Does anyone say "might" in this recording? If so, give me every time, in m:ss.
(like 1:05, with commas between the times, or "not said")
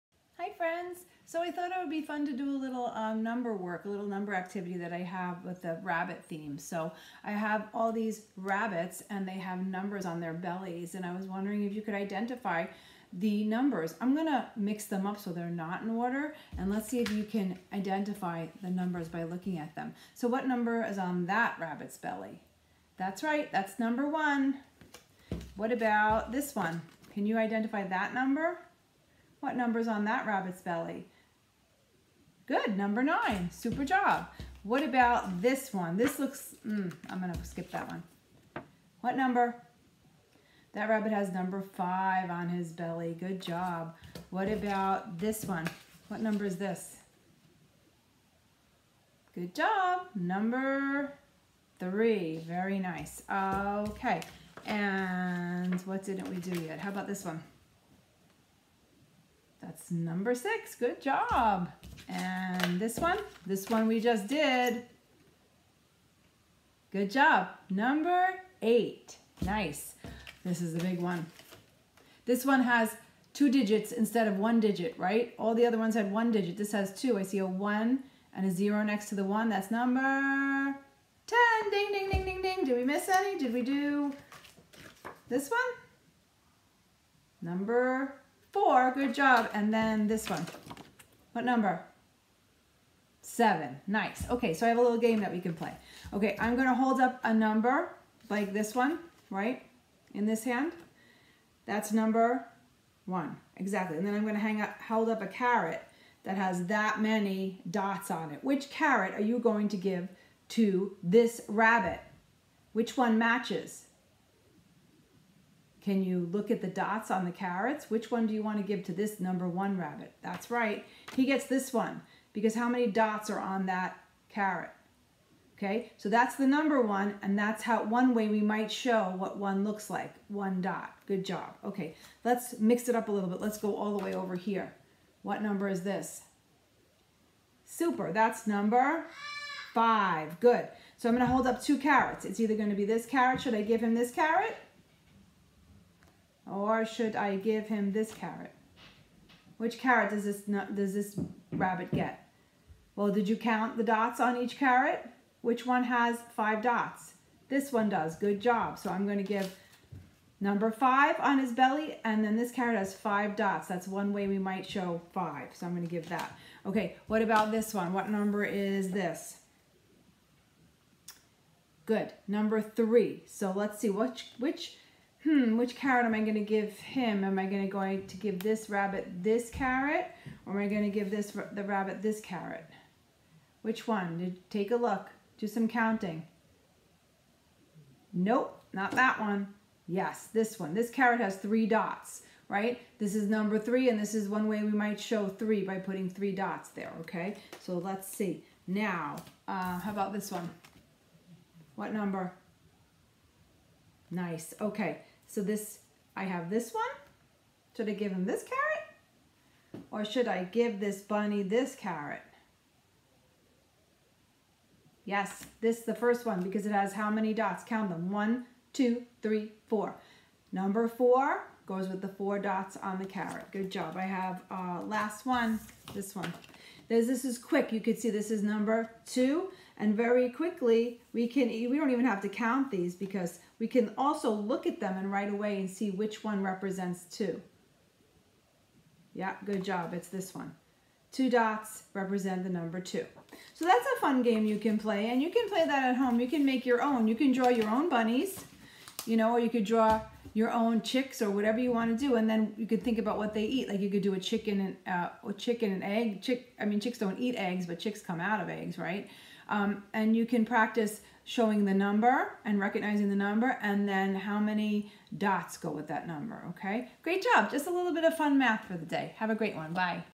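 2:08, 2:44, 3:14.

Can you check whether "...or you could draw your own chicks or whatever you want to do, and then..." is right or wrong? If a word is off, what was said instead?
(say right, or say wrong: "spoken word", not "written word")
right.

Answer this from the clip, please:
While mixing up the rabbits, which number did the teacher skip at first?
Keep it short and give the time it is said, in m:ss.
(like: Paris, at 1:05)
7, at 1:33.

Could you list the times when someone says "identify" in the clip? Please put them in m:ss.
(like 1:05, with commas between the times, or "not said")
0:11, 0:17, 0:27.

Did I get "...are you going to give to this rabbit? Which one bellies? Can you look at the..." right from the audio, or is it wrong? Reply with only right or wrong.
wrong.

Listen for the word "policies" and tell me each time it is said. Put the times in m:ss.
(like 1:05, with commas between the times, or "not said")
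not said.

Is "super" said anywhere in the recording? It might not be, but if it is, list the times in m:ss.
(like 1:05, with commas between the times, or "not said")
0:33, 2:17.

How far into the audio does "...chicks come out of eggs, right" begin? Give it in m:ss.
4:17.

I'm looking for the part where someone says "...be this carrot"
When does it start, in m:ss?
2:22.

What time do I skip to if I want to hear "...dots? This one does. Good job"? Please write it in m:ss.
2:36.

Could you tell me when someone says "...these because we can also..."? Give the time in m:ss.
3:52.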